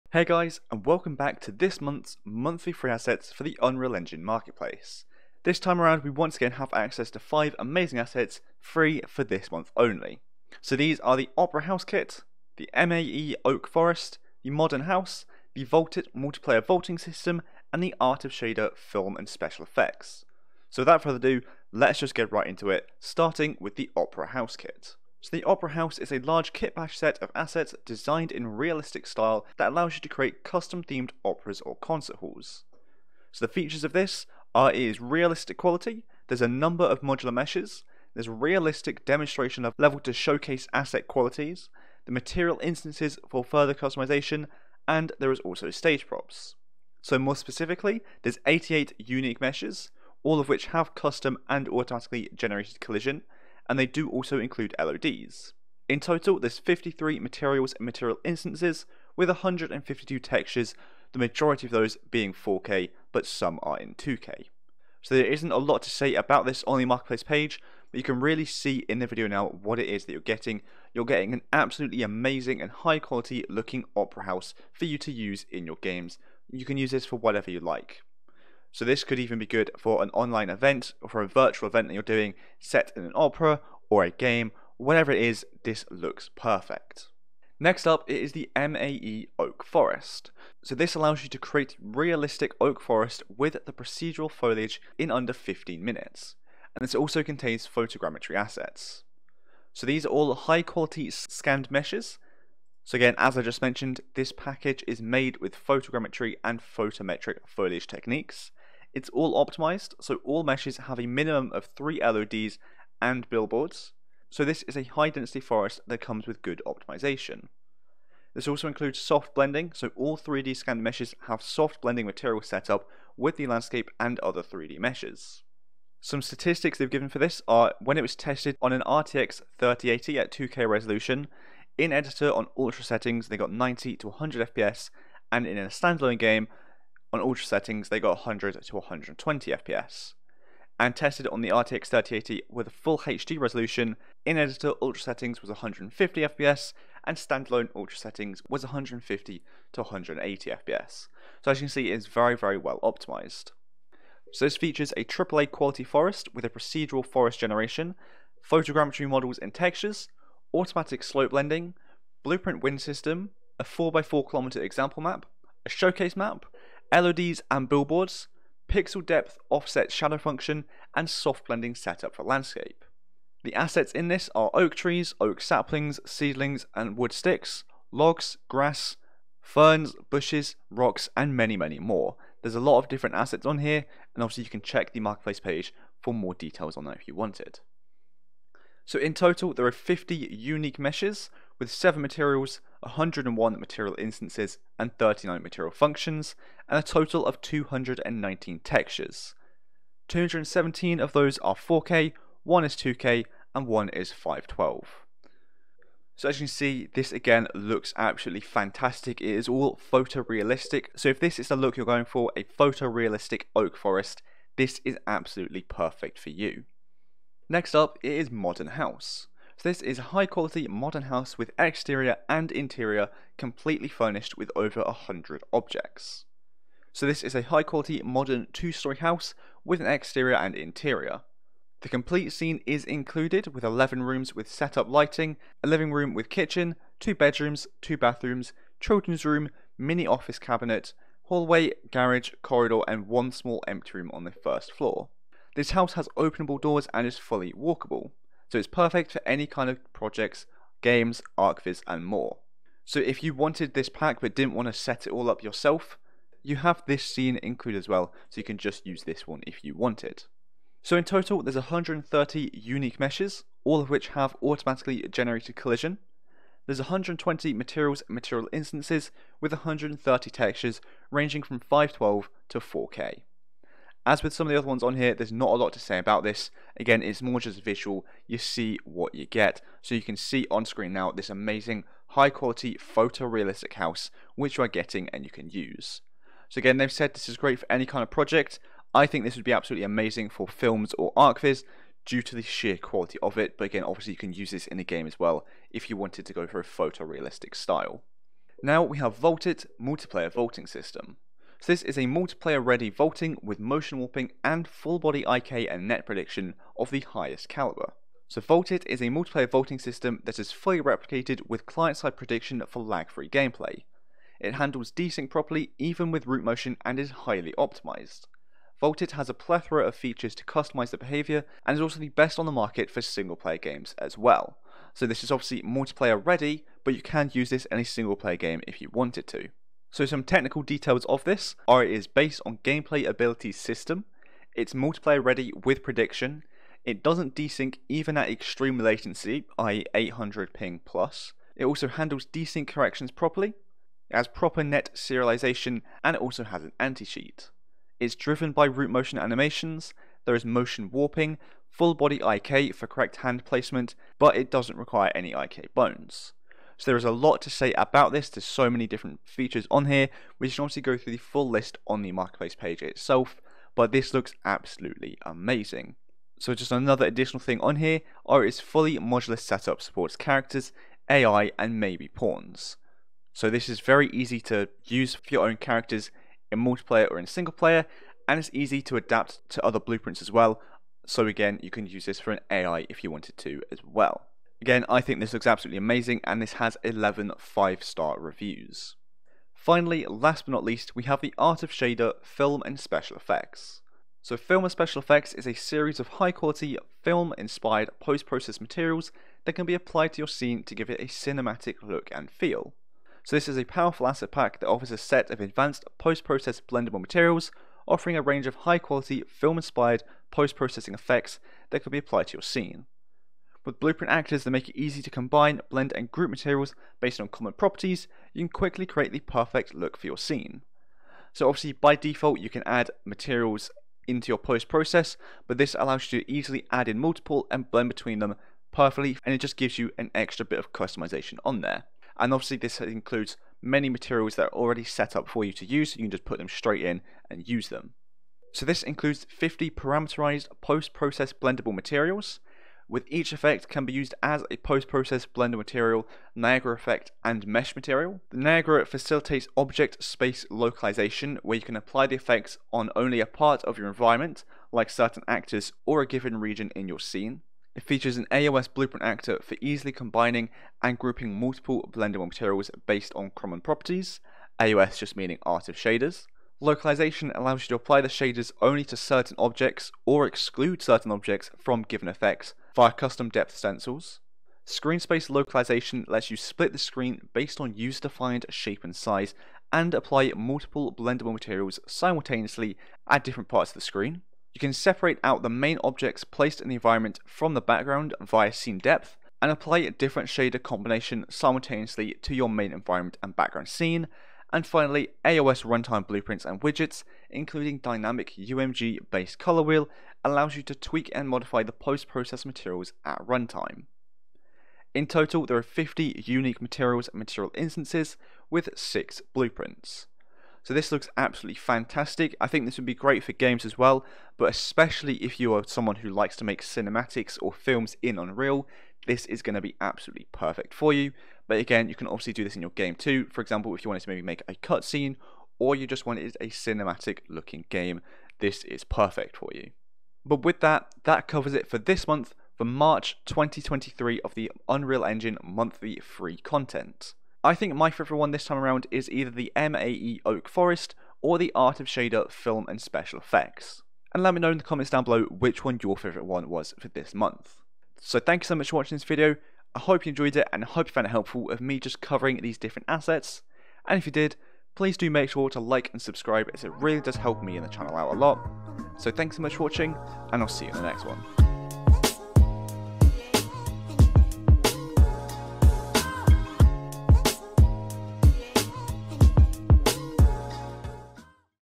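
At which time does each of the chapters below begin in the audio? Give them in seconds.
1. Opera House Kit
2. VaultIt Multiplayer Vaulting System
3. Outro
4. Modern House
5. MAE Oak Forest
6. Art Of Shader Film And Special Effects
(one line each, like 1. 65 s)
1. 25 s
2. 298 s
3. 530 s
4. 217 s
5. 87 s
6. 389 s.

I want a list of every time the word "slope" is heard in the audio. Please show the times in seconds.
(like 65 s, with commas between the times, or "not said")
161 s.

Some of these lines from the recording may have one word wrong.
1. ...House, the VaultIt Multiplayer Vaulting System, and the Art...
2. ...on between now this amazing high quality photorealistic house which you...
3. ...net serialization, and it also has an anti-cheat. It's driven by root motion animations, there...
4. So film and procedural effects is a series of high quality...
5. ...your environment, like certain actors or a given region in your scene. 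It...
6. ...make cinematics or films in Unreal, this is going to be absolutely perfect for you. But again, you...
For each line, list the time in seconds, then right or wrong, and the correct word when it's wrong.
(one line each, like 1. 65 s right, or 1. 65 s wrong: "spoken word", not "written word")
1. 14 s right
2. 280 s wrong: "screen", not "between"
3. 344 s right
4. 394 s wrong: "special", not "procedural"
5. 453 s right
6. 516 s right.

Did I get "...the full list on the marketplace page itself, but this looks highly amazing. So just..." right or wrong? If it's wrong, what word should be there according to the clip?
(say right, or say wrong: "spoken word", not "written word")
wrong: "absolutely", not "highly".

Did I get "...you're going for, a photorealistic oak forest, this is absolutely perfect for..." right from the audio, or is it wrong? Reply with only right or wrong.
right.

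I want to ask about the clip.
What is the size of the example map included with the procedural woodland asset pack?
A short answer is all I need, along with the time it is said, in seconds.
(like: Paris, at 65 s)
4x4km, at 163 s.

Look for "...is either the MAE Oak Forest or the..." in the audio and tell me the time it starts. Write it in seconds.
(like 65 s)
538 s.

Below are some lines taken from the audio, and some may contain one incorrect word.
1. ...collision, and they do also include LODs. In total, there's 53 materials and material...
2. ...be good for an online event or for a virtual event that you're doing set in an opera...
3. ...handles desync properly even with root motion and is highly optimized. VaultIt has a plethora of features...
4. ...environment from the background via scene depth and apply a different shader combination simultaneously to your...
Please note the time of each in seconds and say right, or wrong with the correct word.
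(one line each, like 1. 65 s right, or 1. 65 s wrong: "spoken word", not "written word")
1. 52 s right
2. 79 s right
3. 314 s right
4. 486 s right.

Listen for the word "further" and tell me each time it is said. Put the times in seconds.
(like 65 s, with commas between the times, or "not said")
21 s, 43 s.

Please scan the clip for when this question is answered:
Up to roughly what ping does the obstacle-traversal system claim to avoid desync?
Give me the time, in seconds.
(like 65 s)
339 s.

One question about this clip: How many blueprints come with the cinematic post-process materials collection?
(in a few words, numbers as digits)
6.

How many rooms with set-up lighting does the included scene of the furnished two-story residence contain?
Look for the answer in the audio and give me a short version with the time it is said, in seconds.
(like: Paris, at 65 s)
11, at 233 s.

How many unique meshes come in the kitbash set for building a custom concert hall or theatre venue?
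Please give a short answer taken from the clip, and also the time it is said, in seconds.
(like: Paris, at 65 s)
88, at 48 s.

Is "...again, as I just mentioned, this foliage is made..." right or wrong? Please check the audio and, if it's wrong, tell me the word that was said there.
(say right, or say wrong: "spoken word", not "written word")
wrong: "package", not "foliage".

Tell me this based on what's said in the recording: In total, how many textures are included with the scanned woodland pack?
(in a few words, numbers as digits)
219.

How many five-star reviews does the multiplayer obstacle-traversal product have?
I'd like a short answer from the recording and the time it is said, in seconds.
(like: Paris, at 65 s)
11, at 386 s.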